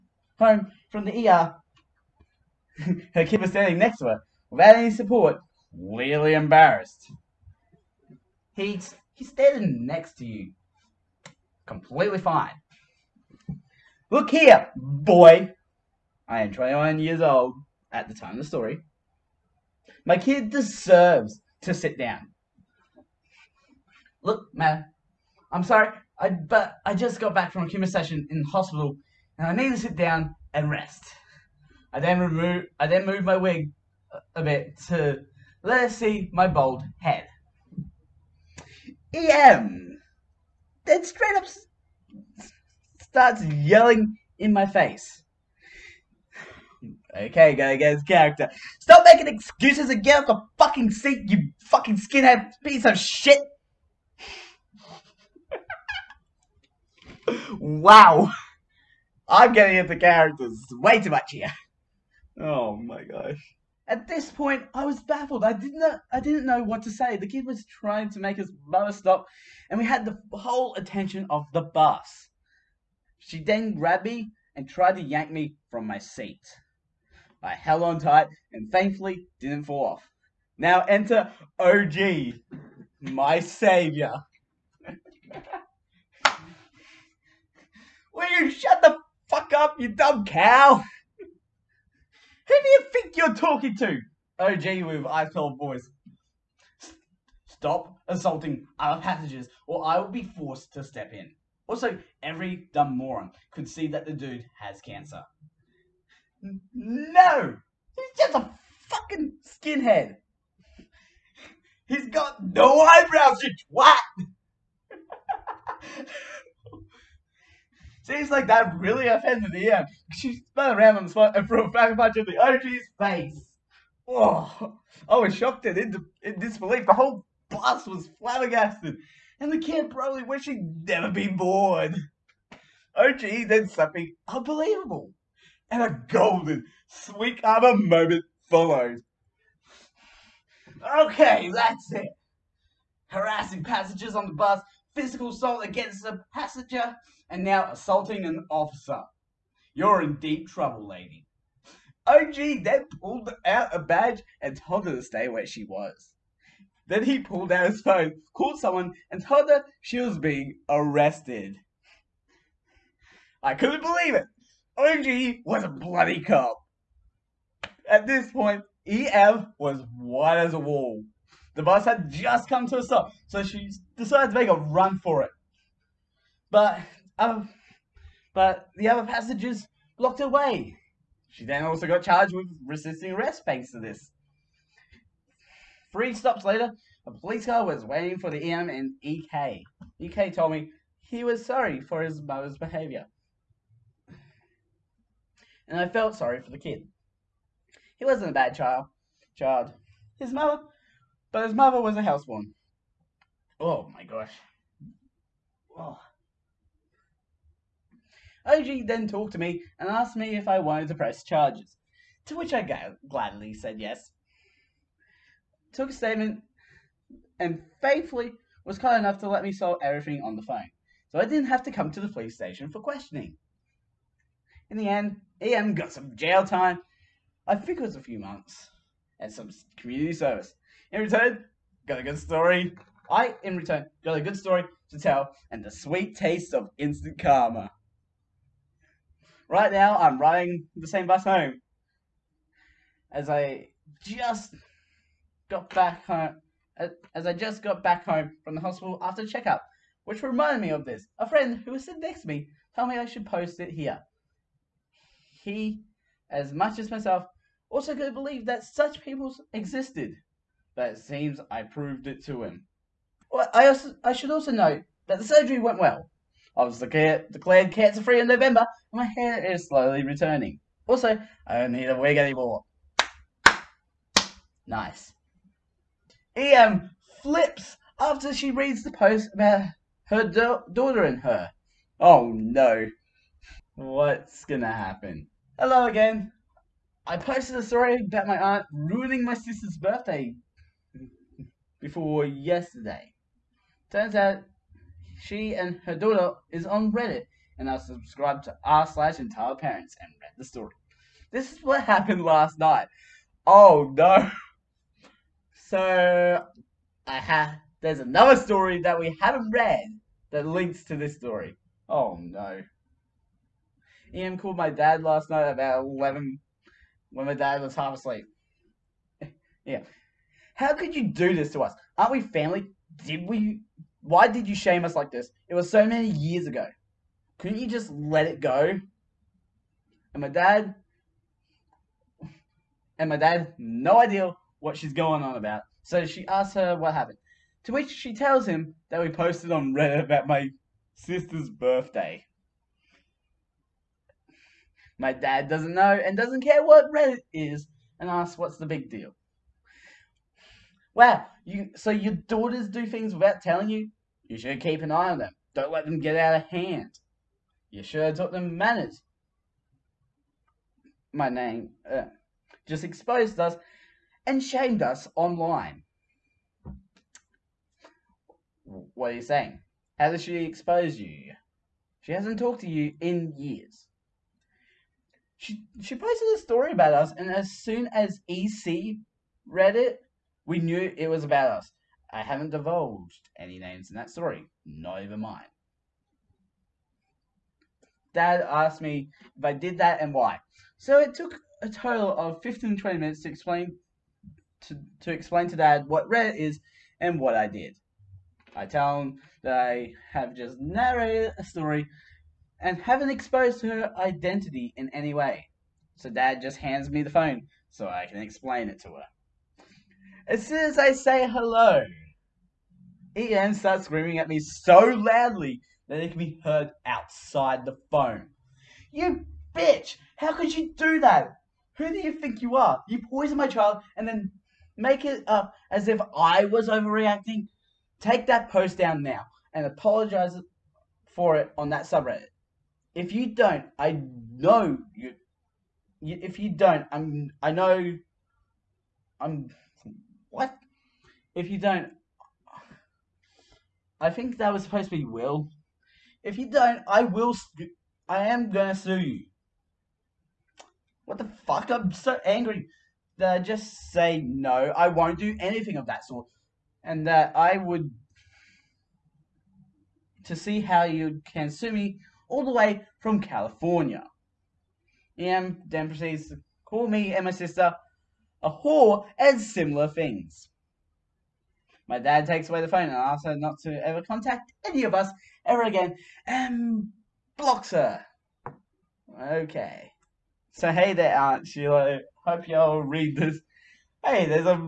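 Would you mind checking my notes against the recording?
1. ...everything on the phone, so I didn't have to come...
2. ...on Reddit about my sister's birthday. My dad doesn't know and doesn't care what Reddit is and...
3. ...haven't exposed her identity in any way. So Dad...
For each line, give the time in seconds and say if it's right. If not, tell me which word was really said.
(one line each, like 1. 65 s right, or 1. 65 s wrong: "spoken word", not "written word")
1. 219 s right
2. 339 s right
3. 402 s right.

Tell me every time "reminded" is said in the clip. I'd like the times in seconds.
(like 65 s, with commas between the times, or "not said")
250 s.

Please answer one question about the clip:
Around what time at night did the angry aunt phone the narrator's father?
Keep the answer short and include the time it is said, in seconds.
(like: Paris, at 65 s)
about 11, at 315 s.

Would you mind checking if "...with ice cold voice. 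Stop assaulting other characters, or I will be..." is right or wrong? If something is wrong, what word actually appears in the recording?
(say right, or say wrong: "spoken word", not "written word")
wrong: "passengers", not "characters".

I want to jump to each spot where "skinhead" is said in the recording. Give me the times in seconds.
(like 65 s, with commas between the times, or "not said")
51 s, 109 s.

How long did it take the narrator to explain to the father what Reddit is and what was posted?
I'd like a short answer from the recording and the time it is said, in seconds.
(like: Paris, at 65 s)
15-20 minutes, at 392 s.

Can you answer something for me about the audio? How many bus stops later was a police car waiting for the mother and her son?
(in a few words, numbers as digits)
3.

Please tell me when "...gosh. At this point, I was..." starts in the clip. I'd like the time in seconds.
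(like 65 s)
63 s.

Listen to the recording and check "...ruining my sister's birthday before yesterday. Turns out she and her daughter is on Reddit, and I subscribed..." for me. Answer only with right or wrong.
right.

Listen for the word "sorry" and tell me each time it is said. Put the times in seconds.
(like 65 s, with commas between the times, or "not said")
25 s, 191 s, 196 s.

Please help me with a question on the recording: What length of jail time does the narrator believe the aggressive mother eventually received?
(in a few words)
a few months.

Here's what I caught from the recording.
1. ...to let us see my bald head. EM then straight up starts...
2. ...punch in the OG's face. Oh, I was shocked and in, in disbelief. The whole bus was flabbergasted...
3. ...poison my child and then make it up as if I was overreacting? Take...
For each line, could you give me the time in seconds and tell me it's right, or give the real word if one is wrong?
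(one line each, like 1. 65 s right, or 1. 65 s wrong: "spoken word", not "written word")
1. 34 s right
2. 121 s right
3. 423 s right.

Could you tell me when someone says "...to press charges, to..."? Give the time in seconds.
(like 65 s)
210 s.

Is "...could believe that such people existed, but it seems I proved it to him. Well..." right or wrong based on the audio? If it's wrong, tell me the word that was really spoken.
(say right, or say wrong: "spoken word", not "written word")
right.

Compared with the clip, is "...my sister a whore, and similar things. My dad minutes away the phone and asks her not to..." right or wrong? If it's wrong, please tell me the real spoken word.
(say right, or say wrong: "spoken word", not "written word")
wrong: "takes", not "minutes".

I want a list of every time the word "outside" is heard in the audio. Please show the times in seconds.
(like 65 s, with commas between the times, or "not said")
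416 s.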